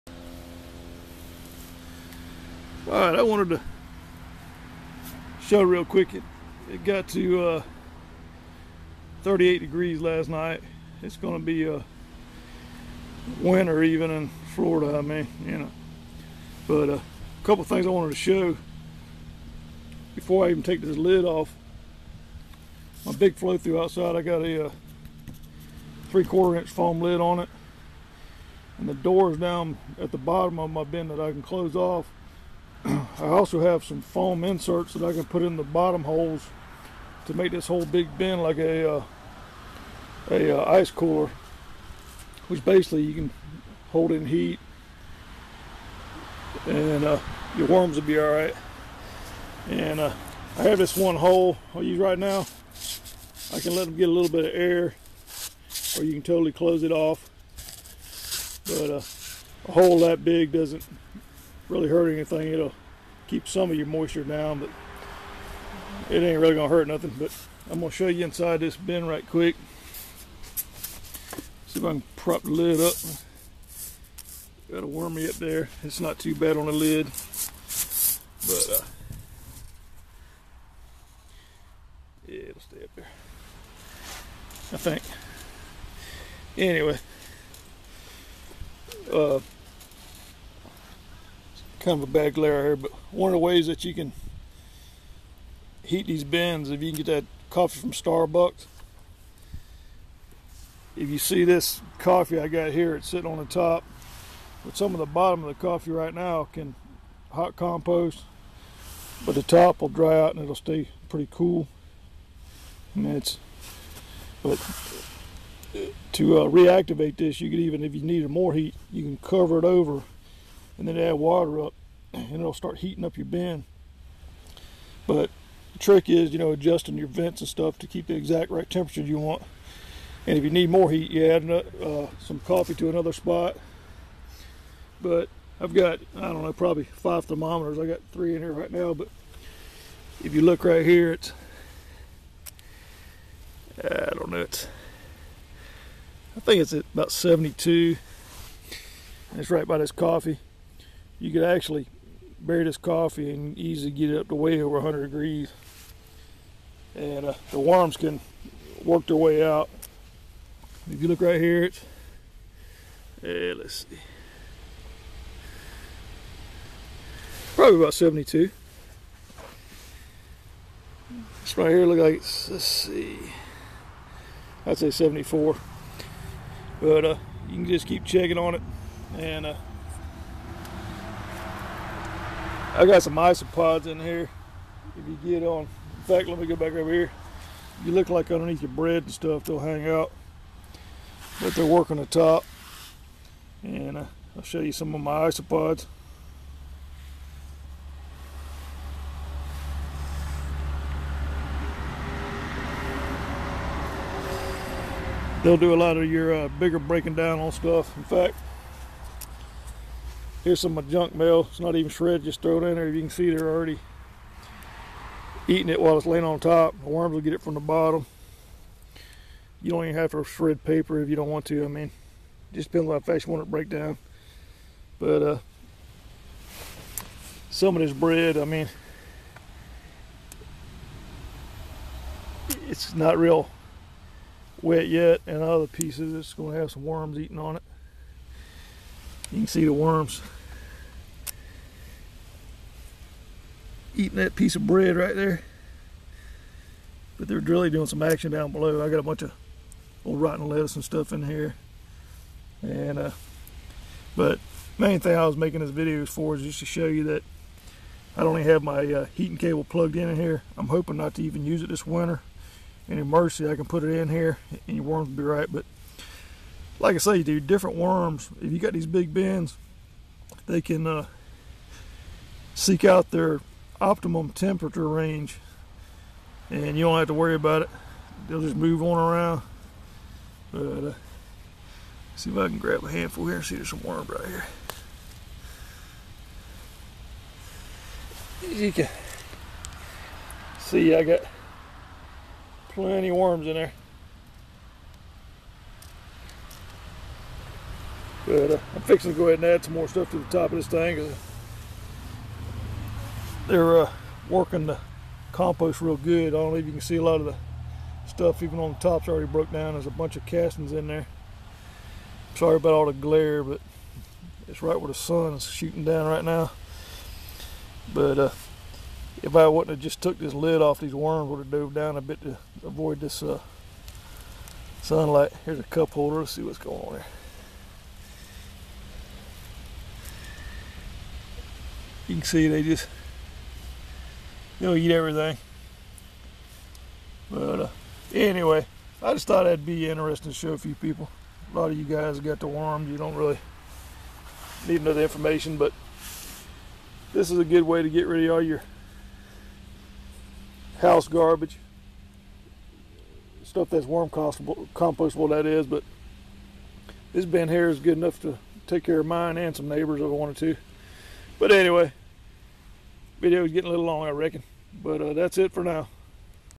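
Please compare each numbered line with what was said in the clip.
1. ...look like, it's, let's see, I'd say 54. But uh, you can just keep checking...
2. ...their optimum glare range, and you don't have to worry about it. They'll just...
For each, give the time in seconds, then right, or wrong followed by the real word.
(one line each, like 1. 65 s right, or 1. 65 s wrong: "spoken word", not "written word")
1. 171 s wrong: "74", not "54"
2. 273 s wrong: "temperature", not "glare".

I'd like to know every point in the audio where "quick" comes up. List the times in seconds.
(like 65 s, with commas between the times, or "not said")
5 s, 69 s.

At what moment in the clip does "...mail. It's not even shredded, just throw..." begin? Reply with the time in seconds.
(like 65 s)
211 s.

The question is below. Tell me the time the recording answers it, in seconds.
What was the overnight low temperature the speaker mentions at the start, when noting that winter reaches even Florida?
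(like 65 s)
9 s.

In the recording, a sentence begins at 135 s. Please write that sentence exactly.
But I've got, I don't know, probably five thermometers.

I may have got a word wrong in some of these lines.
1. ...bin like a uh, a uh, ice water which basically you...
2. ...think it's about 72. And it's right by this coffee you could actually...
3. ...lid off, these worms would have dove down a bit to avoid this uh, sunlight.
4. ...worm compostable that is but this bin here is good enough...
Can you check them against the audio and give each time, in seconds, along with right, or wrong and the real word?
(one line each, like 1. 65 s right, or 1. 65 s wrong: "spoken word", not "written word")
1. 38 s wrong: "cooler", not "water"
2. 146 s right
3. 320 s right
4. 353 s right.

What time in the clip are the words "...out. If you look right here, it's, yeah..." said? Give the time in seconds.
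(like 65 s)
159 s.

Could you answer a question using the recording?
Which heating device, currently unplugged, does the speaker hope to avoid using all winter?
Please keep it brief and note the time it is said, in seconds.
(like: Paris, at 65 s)
Heating cable, at 259 s.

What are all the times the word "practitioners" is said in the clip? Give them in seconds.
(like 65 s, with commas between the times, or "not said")
not said.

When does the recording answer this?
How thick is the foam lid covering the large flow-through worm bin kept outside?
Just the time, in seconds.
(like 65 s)
26 s.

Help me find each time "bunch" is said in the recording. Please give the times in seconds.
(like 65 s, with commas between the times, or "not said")
249 s, 309 s.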